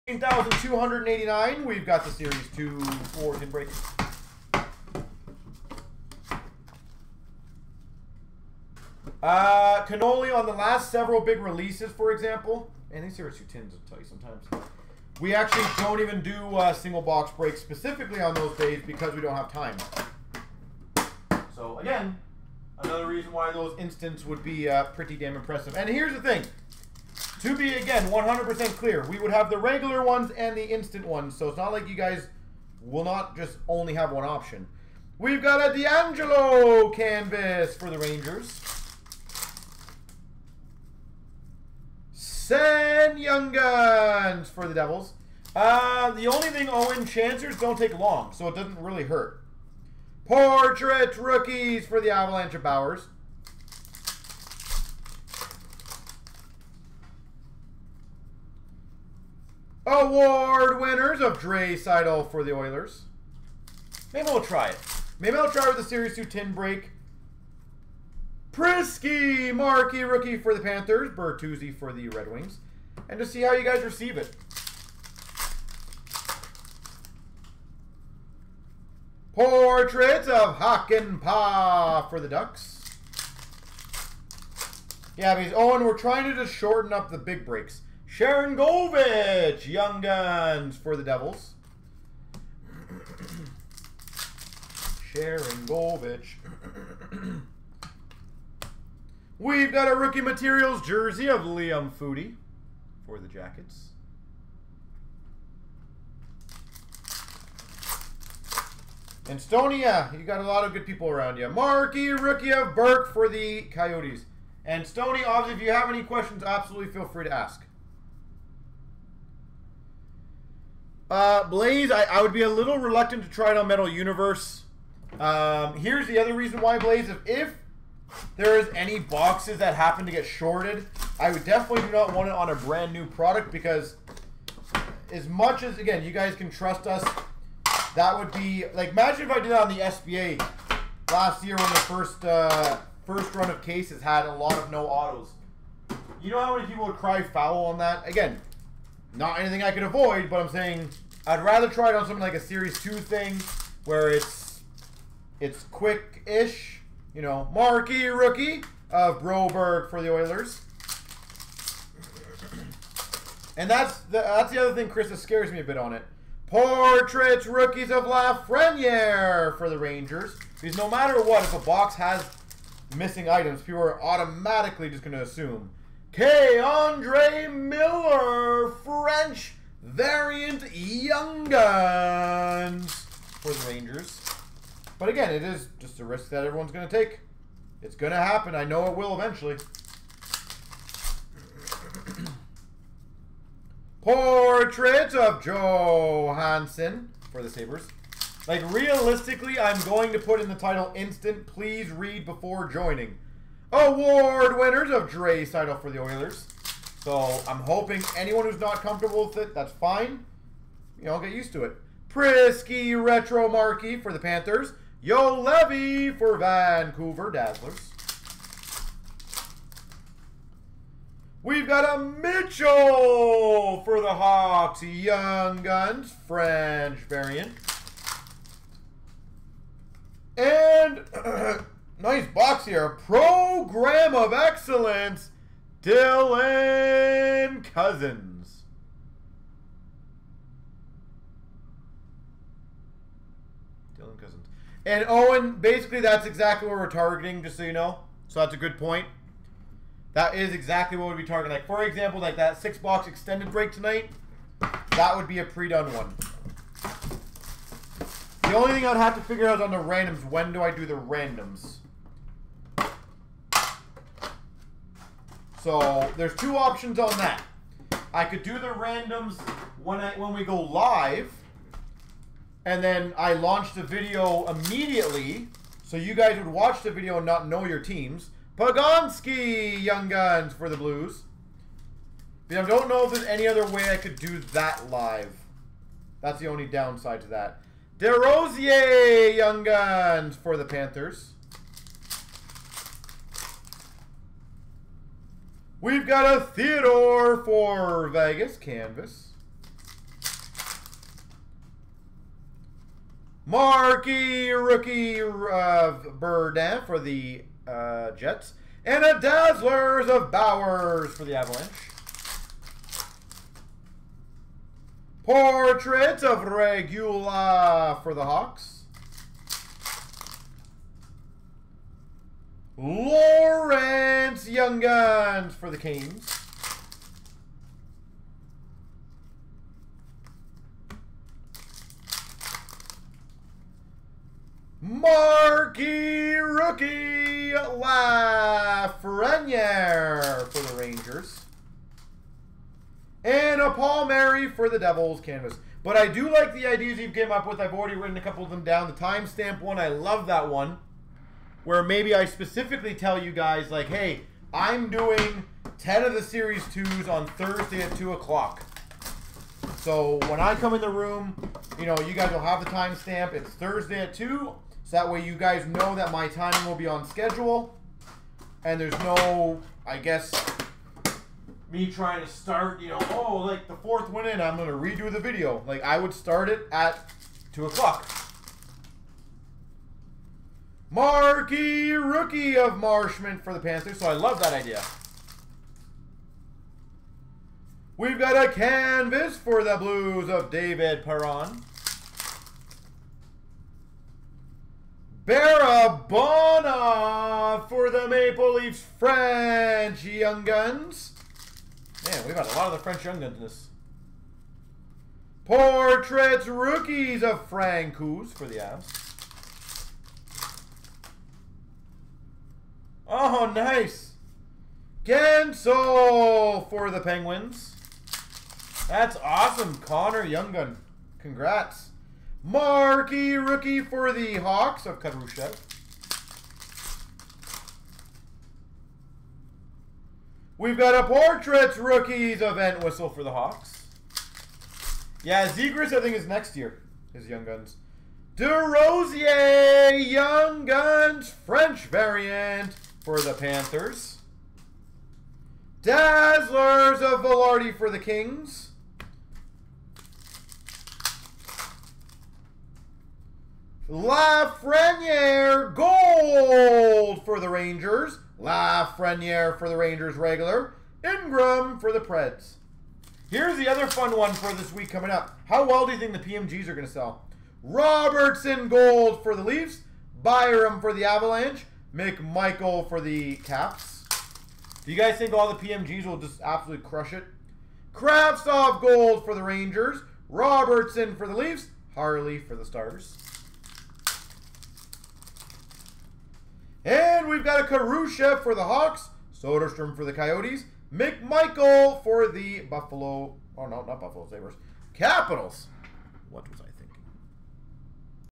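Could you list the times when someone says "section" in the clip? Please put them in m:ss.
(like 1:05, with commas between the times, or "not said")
not said.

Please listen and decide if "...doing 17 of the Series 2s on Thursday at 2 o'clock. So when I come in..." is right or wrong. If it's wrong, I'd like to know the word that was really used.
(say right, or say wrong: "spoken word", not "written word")
wrong: "10", not "17".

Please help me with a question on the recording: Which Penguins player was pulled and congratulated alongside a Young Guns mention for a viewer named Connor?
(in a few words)
Guentzel.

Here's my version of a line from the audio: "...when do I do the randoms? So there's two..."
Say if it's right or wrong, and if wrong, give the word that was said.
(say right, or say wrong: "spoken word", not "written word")
right.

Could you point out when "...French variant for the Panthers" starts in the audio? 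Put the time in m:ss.
7:21.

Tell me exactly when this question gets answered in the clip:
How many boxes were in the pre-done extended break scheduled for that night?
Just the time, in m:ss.
4:12.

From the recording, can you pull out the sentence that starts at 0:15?
We actually don't even do uh, single box breaks specifically on those days because we don't have time.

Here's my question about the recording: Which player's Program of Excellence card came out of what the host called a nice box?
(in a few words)
Dylan Cozens.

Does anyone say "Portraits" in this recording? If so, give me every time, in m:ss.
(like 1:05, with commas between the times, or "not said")
0:50, 1:19, 2:46, 3:14, 5:15, 6:45, 7:11.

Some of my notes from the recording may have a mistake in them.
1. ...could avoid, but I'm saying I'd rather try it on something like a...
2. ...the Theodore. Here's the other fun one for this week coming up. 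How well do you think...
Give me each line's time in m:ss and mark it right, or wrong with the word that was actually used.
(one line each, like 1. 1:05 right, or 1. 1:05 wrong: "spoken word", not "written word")
1. 2:29 right
2. 7:41 wrong: "Preds", not "Theodore".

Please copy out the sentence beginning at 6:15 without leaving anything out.
Like, I would start it at 2 o'clock.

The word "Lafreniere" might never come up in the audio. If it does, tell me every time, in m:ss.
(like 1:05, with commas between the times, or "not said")
2:48, 5:37, 7:33, 7:38.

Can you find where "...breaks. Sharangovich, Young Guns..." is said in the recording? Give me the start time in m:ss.
1:27.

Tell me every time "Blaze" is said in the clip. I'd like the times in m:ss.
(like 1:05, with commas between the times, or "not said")
2:01, 2:06.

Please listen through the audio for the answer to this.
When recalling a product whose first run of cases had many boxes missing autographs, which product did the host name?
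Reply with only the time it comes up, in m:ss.
2:19.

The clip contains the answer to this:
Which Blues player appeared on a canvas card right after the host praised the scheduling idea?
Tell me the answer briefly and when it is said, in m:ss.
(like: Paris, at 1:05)
David Perron, at 6:30.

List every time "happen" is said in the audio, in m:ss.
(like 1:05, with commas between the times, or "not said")
2:09, 3:08.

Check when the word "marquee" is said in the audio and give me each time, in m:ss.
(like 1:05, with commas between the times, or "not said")
1:09, 1:51, 2:37, 5:03, 5:34, 6:20, 7:02.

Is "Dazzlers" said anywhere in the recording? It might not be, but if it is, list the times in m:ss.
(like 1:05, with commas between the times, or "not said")
3:37, 5:09, 7:25.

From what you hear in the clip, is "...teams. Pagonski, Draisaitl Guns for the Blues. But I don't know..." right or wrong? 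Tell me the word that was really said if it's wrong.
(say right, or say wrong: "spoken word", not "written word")
wrong: "Young", not "Draisaitl".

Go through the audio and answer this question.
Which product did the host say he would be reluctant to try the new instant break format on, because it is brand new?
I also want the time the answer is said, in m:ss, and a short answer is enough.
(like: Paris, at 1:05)
Metal Universe, at 2:03.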